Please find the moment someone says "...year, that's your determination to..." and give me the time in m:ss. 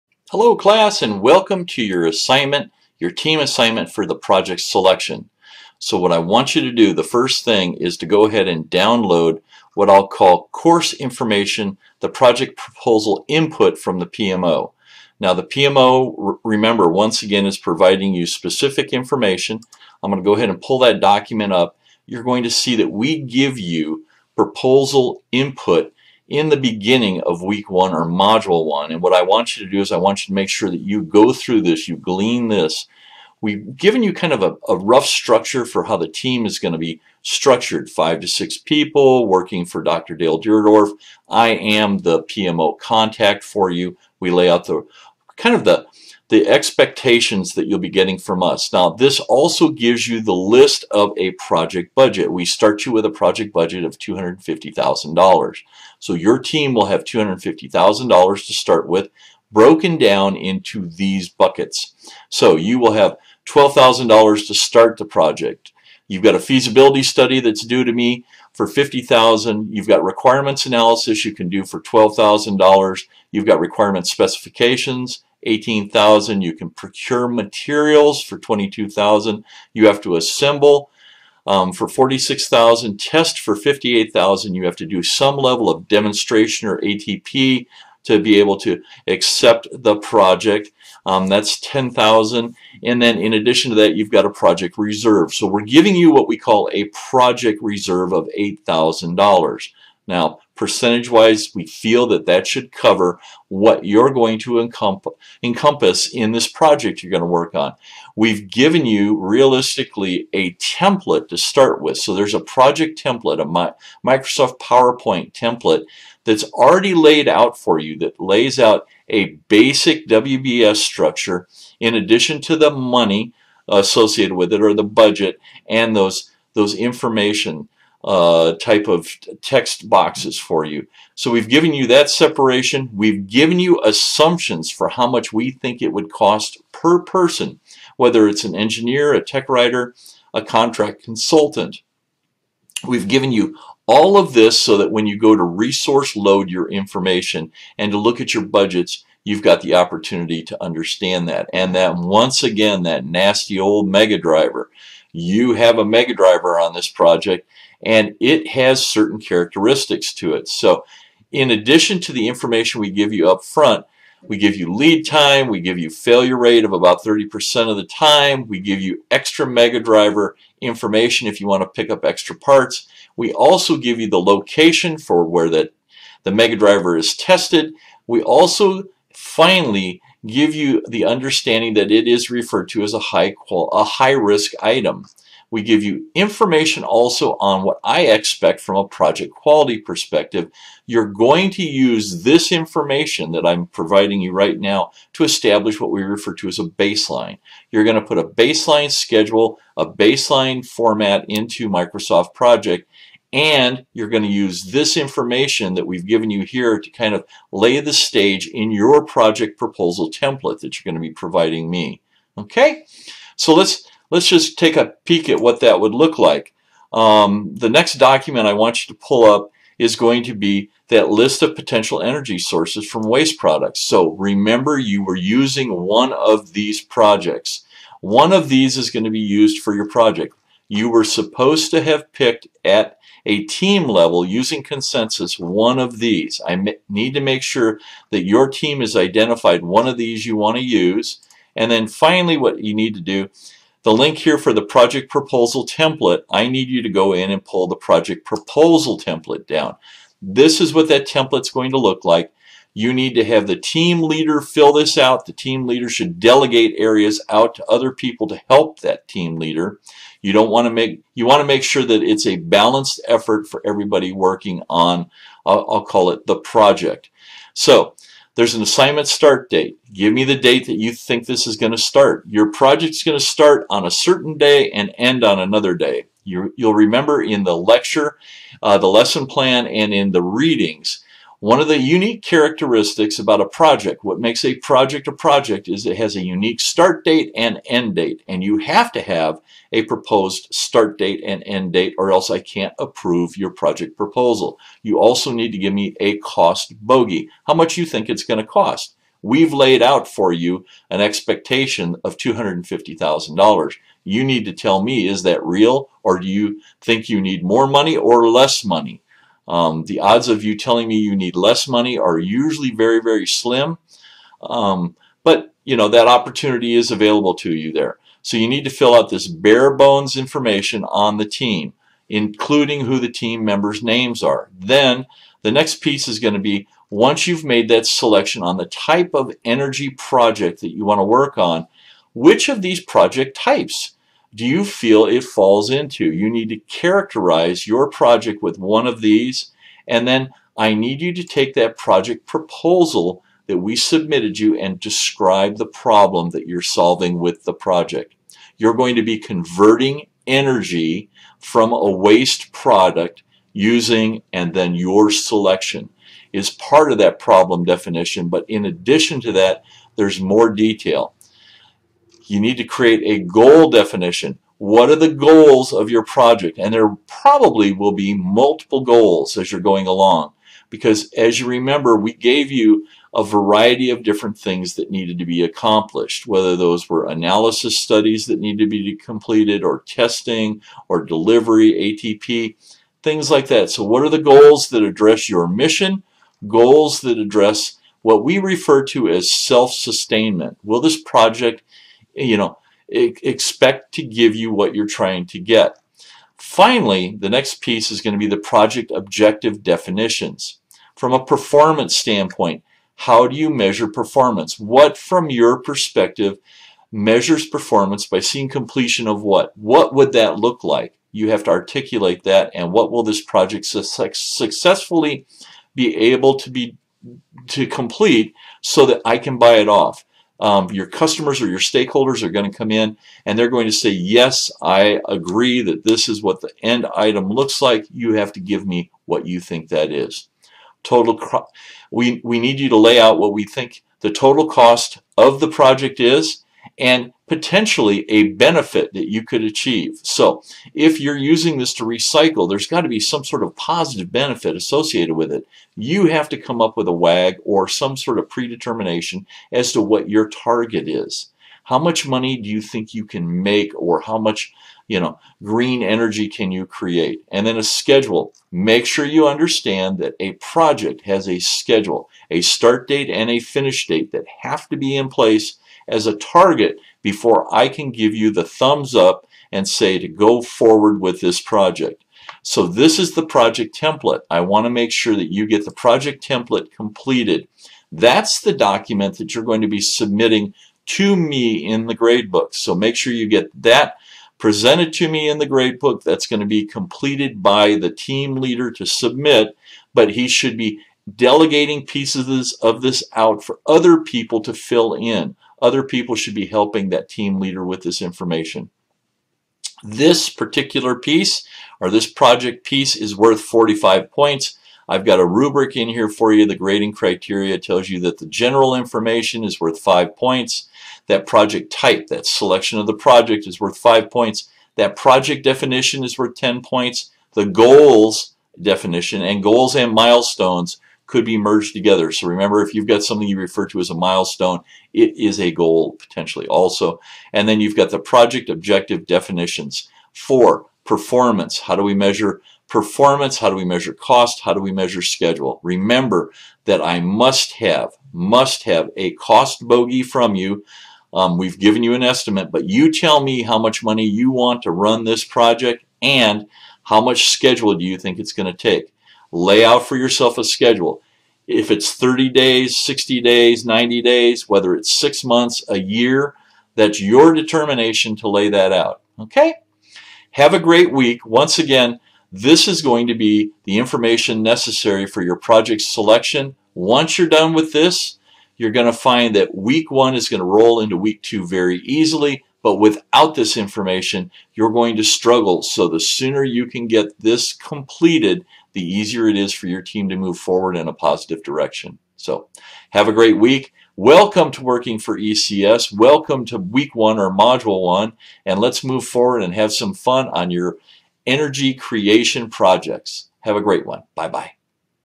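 9:15.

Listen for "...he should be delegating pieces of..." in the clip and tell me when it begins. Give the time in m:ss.
8:10.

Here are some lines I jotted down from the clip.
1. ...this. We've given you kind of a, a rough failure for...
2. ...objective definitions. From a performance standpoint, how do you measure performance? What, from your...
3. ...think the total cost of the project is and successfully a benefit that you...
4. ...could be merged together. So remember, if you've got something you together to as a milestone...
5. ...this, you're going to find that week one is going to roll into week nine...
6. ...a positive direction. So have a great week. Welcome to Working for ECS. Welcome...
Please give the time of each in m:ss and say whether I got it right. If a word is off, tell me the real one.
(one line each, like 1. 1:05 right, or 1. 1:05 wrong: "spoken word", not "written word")
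1. 0:32 wrong: "structure", not "failure"
2. 6:38 right
3. 7:13 wrong: "potentially", not "successfully"
4. 8:41 wrong: "refer", not "together"
5. 9:27 wrong: "two", not "nine"
6. 9:40 right.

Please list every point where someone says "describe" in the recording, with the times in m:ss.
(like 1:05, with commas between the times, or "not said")
5:44.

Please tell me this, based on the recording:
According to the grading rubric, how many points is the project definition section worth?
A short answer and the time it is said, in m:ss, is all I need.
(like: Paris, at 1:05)
10, at 8:36.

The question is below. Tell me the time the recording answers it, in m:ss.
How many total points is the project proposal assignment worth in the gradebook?
8:23.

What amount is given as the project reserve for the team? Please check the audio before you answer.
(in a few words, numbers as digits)
$8,000.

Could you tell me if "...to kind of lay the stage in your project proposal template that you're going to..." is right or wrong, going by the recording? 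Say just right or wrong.
right.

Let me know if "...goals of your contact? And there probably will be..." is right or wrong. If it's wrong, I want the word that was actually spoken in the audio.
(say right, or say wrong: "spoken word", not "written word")
wrong: "project", not "contact".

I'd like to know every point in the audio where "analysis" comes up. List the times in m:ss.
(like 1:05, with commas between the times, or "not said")
1:10, 6:17.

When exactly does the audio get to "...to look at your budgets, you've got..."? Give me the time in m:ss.
2:27.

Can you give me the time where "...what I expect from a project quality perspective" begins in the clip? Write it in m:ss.
3:07.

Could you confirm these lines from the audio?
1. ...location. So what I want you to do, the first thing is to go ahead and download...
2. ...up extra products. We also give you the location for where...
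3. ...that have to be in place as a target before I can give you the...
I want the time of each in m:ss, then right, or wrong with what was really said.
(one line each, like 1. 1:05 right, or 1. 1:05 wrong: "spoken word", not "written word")
1. 0:04 wrong: "selection", not "location"
2. 2:51 wrong: "parts", not "products"
3. 7:44 right.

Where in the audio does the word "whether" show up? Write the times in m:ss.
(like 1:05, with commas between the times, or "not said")
2:17, 6:16, 9:14.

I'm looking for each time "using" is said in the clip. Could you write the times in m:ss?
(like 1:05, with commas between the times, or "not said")
3:45, 3:54, 5:53, 7:21.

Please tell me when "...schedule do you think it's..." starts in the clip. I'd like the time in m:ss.
9:07.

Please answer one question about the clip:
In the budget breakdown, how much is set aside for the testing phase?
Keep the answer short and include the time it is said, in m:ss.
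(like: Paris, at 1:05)
$58,000, at 1:23.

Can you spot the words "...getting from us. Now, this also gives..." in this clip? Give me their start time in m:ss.
0:47.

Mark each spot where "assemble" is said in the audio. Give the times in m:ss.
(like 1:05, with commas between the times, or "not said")
1:20.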